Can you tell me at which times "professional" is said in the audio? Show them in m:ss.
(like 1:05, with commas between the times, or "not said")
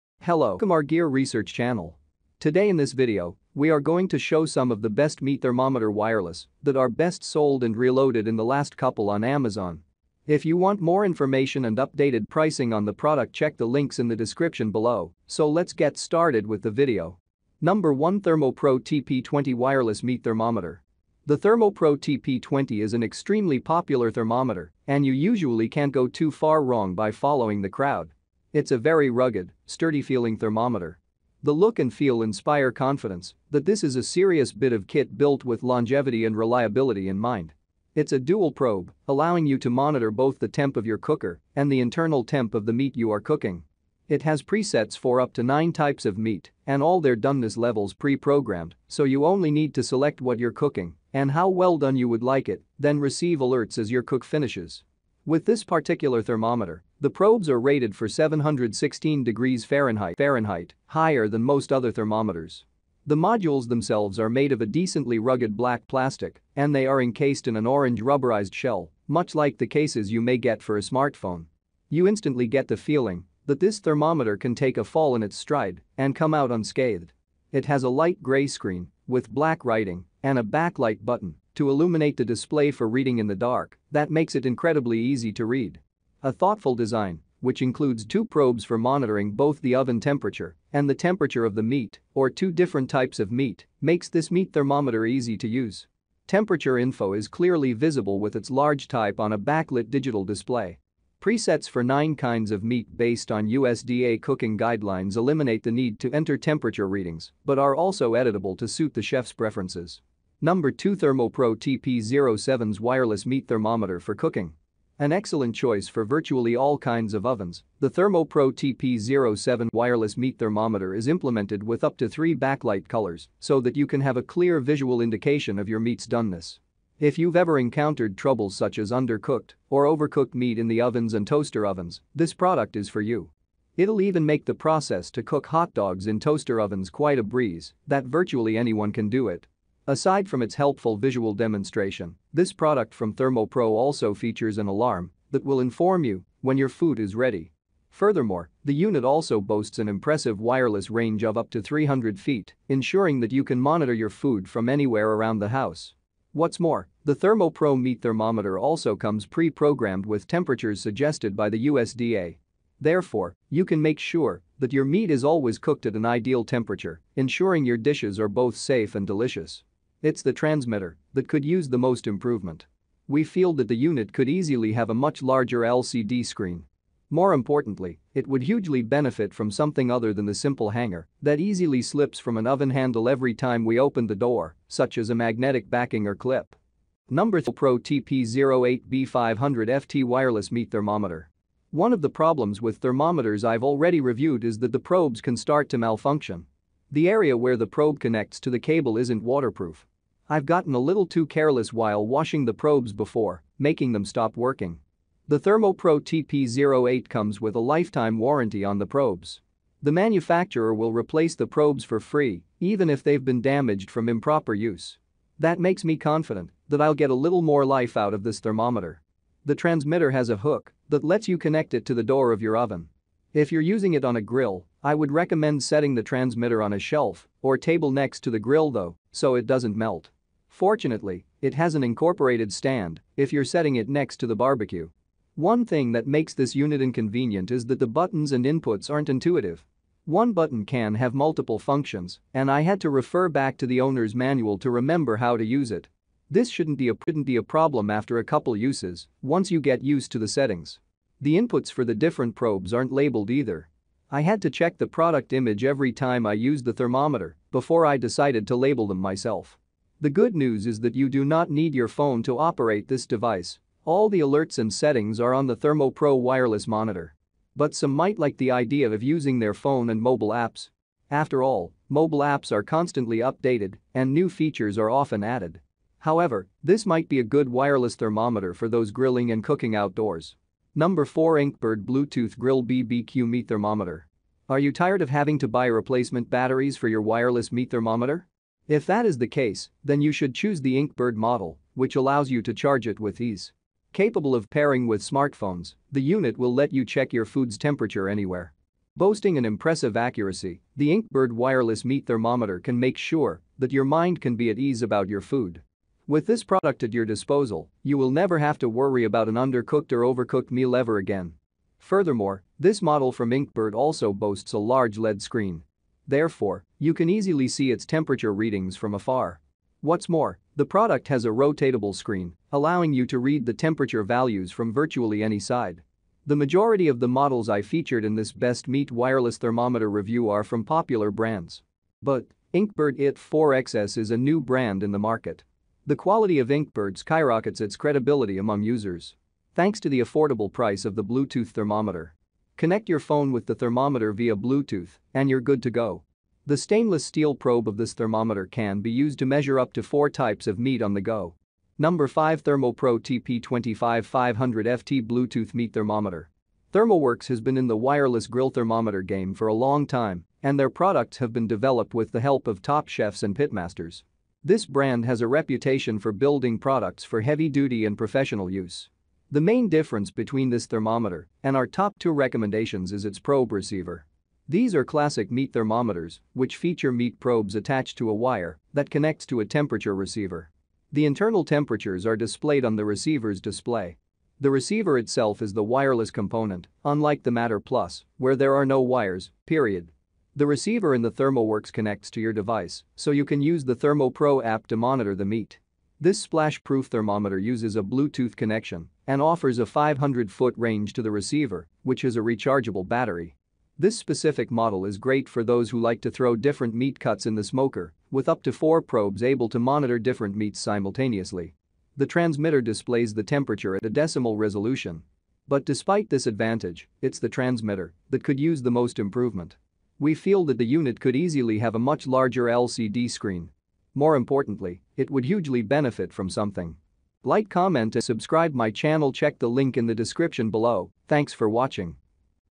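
6:07.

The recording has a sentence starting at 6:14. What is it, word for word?
These are classic meat thermometers, which feature meat probes attached to a wire that connects to a temperature receiver.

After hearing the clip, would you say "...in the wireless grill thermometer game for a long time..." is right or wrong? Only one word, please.
right.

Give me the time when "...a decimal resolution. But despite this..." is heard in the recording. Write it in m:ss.
6:53.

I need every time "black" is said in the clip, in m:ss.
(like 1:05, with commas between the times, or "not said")
1:05, 1:19.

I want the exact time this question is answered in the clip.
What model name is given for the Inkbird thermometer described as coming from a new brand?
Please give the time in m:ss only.
5:32.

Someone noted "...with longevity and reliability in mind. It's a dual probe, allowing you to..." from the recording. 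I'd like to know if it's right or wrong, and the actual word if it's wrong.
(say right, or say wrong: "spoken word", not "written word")
right.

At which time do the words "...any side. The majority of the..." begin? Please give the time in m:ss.
5:25.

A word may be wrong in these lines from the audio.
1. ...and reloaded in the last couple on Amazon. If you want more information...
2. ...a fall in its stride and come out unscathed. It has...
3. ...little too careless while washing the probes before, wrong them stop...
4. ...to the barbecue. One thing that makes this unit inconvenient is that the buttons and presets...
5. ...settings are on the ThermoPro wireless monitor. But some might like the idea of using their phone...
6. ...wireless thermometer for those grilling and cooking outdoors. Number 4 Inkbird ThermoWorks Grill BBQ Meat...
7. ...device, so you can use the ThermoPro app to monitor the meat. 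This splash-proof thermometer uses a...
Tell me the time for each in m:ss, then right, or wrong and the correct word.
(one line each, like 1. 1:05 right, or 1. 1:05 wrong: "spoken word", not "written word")
1. 0:07 right
2. 1:14 right
3. 3:20 wrong: "making", not "wrong"
4. 3:54 wrong: "inputs", not "presets"
5. 4:24 right
6. 4:37 wrong: "Bluetooth", not "ThermoWorks"
7. 6:32 right.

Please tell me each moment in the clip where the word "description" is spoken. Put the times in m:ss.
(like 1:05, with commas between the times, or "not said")
0:14, 7:09.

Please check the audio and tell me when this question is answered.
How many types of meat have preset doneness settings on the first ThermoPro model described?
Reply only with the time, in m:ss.
0:45.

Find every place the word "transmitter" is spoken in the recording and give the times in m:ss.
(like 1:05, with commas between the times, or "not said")
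2:50, 3:39, 3:46, 6:52, 6:57.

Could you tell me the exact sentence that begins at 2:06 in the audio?
If you've ever encountered troubles such as undercooked or overcooked meat in the ovens and toaster ovens, this product is for you.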